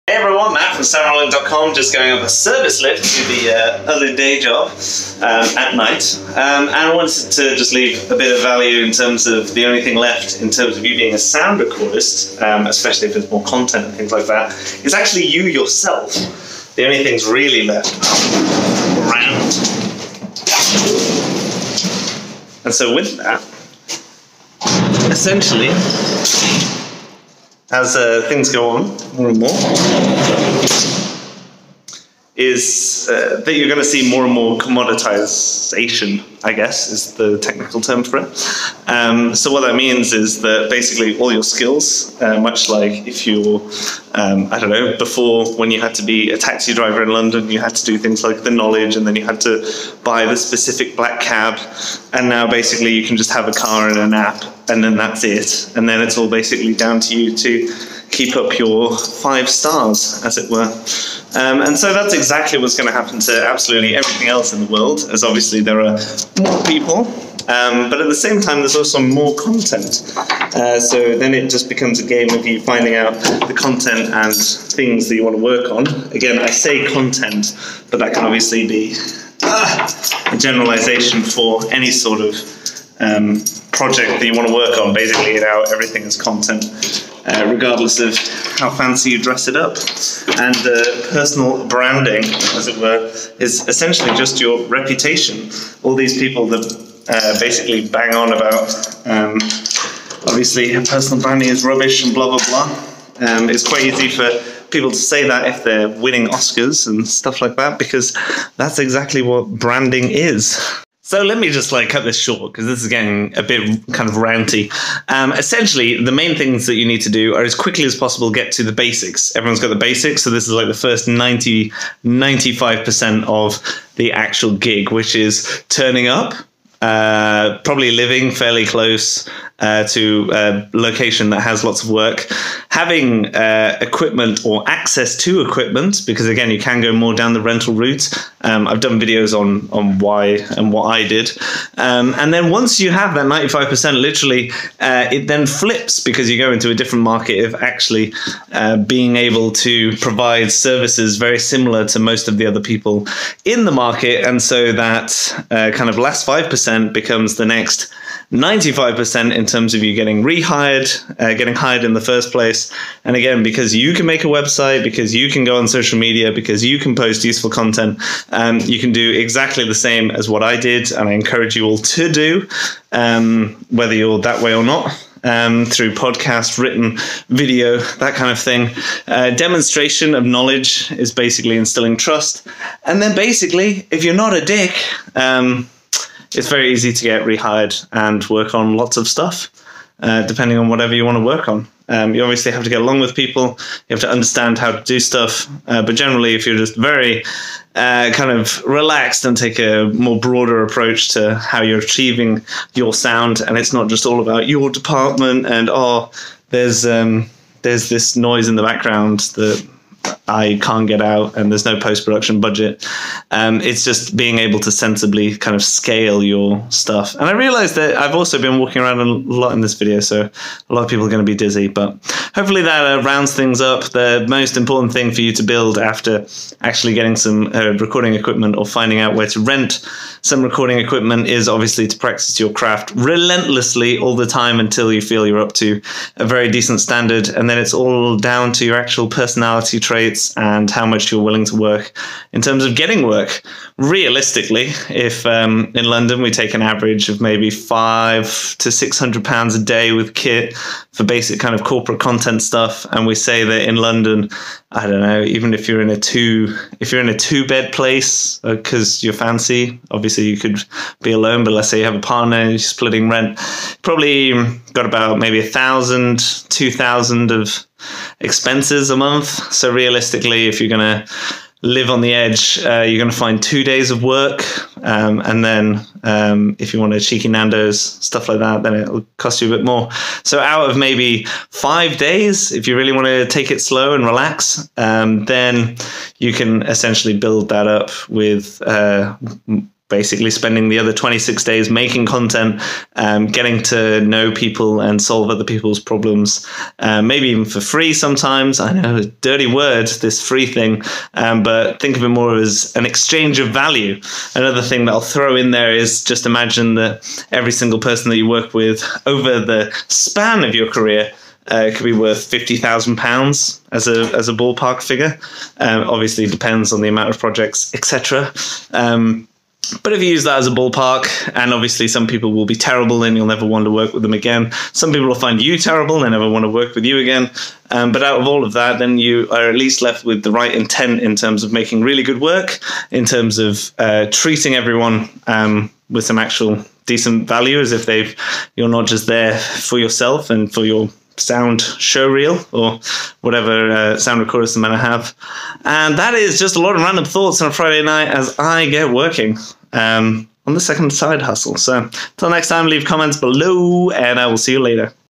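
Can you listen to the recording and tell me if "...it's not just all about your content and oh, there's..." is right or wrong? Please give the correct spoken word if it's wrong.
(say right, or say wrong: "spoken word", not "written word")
wrong: "department", not "content".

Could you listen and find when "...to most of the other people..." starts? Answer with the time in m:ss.
2:31.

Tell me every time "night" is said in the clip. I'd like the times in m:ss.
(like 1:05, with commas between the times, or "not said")
0:05, 5:47.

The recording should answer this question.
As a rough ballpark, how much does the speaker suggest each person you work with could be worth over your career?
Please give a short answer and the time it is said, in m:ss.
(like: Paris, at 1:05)
£50,000, at 5:12.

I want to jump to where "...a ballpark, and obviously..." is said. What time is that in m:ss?
5:20.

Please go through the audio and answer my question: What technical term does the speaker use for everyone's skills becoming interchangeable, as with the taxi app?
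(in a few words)
commoditization.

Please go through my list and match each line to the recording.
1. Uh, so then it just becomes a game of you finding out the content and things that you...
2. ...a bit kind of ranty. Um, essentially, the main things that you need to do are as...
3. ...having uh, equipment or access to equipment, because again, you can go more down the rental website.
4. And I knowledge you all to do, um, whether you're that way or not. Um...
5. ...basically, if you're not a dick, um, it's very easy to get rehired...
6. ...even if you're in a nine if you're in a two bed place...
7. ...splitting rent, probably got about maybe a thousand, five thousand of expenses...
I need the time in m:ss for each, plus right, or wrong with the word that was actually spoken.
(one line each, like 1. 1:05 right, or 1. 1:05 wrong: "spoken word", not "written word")
1. 1:10 right
2. 1:53 right
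3. 2:12 wrong: "route", not "website"
4. 2:50 wrong: "encourage", not "knowledge"
5. 3:03 right
6. 4:15 wrong: "two", not "nine"
7. 4:22 wrong: "two", not "five".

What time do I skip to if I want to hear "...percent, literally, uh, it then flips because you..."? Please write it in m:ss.
2:23.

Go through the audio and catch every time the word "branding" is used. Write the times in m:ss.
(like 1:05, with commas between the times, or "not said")
1:31, 1:41, 1:49.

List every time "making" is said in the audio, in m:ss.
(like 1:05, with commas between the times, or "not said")
4:51, 5:31.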